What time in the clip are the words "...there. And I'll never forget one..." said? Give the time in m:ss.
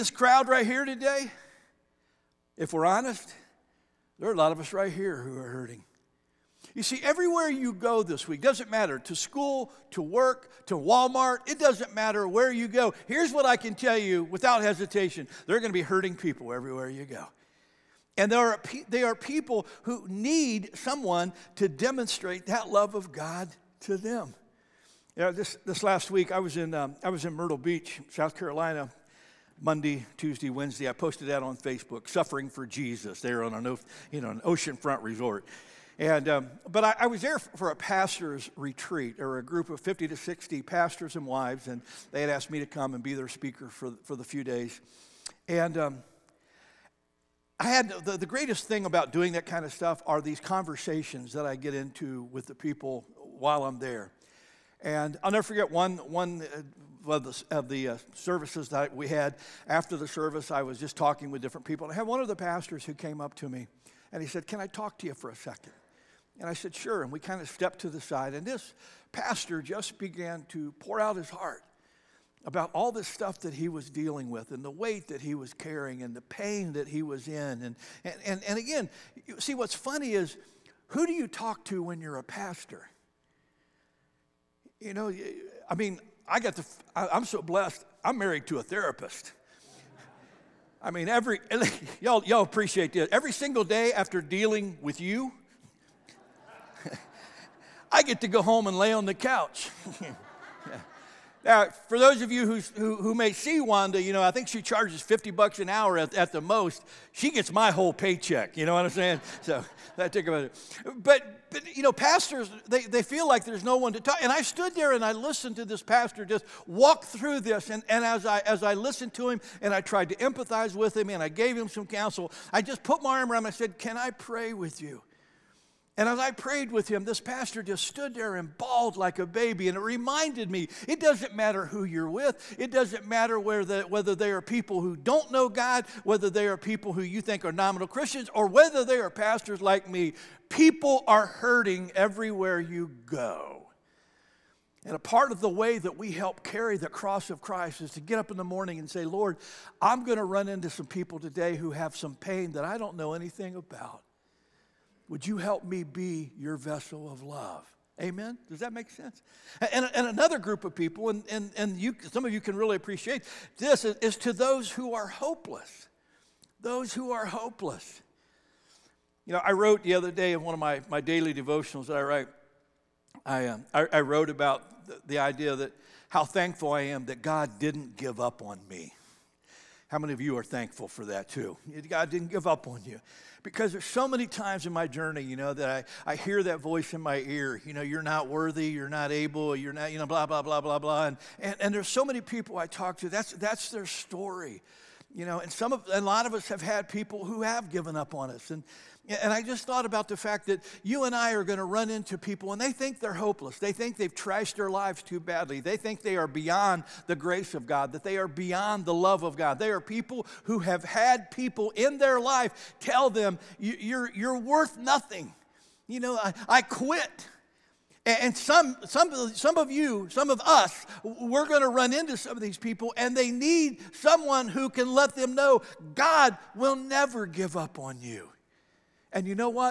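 0:53.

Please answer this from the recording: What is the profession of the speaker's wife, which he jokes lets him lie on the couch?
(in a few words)
Therapist.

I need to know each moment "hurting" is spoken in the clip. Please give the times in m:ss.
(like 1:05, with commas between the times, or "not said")
0:05, 0:15, 2:21.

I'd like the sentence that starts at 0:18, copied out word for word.
And there are, they are people who need someone to demonstrate that love of God to them.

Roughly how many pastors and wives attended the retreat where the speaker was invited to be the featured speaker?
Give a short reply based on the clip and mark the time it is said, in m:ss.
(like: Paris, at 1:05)
50 to 60, at 0:39.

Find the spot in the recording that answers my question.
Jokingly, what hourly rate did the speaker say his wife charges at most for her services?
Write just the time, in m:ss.
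1:45.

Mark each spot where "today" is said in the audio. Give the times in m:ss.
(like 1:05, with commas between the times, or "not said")
0:00, 2:31.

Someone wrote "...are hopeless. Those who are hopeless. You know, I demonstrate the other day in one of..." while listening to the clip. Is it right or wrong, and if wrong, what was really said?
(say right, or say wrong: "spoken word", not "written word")
wrong: "wrote", not "demonstrate".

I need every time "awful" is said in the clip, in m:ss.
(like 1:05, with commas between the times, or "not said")
not said.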